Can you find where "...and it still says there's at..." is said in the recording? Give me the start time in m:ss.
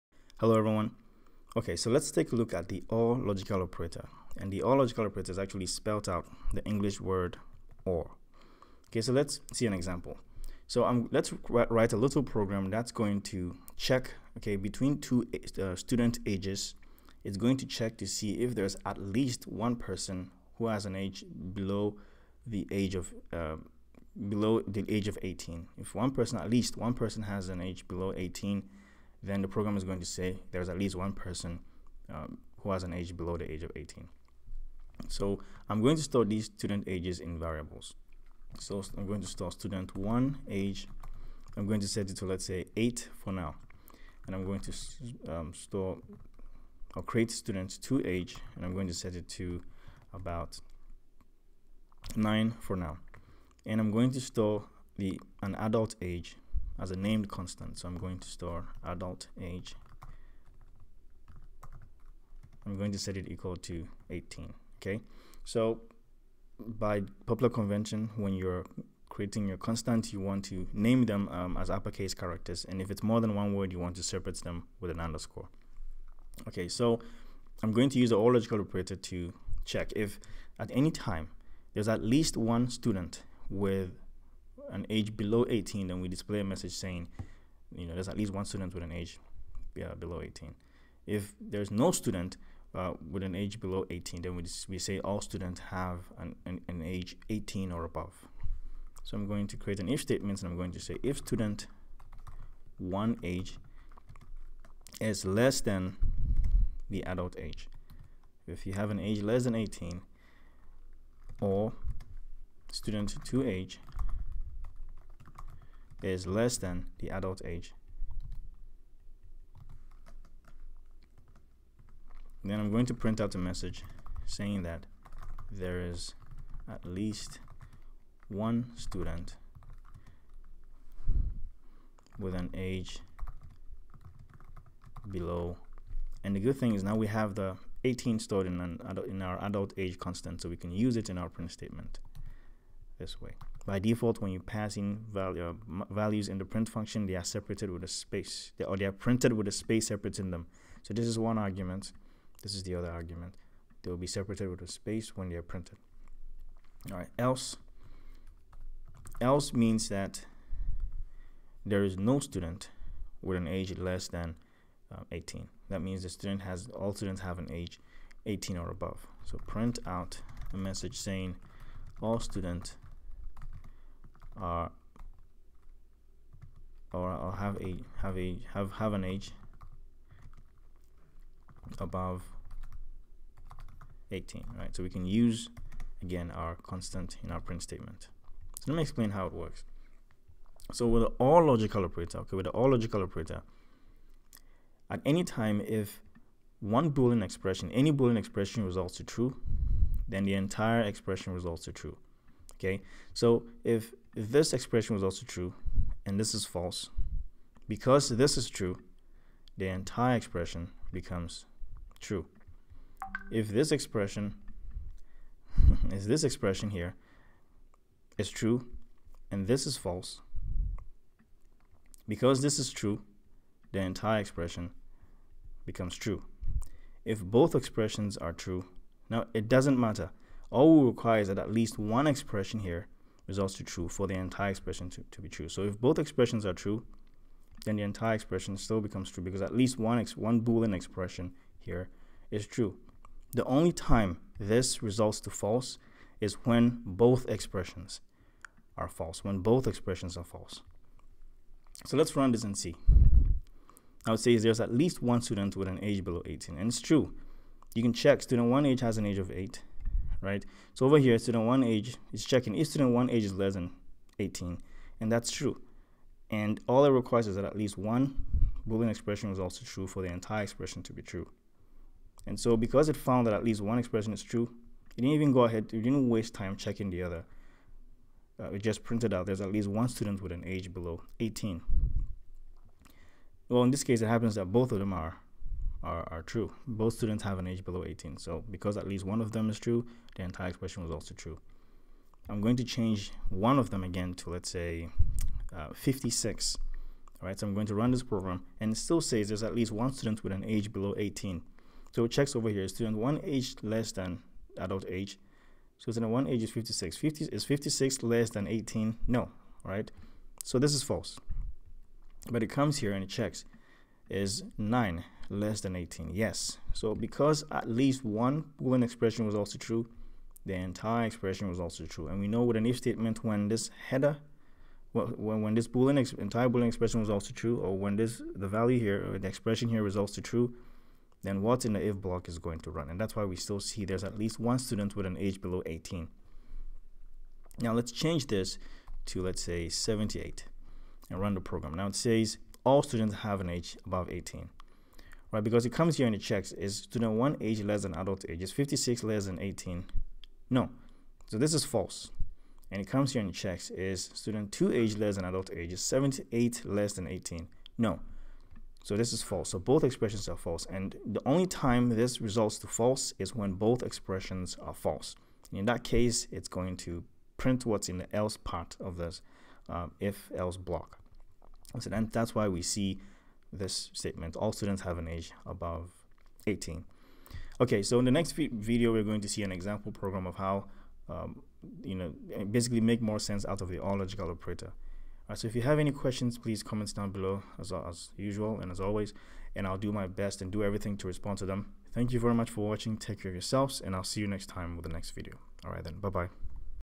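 4:58.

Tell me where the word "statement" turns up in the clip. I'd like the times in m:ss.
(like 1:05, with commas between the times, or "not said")
1:40, 2:21, 3:07, 5:22, 6:13.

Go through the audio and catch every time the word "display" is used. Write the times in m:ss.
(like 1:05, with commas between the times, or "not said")
1:26.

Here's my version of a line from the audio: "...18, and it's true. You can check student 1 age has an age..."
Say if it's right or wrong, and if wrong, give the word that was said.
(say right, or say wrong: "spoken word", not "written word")
right.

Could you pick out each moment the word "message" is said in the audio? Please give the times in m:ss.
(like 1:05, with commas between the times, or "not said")
1:26, 2:03, 2:50.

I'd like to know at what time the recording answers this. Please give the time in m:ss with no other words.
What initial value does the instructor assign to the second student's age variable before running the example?
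0:52.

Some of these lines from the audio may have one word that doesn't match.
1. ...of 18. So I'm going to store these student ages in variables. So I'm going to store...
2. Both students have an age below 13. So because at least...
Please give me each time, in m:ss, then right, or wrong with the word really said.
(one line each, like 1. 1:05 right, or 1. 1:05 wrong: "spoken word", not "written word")
1. 0:33 right
2. 4:46 wrong: "18", not "13".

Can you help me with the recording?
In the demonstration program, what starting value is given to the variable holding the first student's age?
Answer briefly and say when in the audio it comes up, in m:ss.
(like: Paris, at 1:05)
8, at 0:42.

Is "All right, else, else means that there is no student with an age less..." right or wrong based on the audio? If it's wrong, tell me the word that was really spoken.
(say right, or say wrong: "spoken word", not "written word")
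right.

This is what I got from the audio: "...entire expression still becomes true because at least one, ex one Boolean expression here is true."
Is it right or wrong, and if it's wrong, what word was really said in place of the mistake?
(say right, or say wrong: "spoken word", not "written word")
right.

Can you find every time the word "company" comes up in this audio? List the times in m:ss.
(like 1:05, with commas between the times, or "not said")
not said.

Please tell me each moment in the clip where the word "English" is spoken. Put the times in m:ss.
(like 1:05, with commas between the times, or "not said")
0:06.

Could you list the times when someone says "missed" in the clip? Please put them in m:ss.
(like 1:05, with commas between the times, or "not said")
not said.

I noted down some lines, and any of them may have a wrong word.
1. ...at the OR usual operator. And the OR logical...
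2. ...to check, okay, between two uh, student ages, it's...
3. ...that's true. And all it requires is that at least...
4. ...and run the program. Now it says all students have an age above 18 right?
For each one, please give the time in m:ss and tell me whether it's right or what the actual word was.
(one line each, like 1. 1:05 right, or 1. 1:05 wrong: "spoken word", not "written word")
1. 0:02 wrong: "logical", not "usual"
2. 0:13 right
3. 4:25 right
4. 5:41 right.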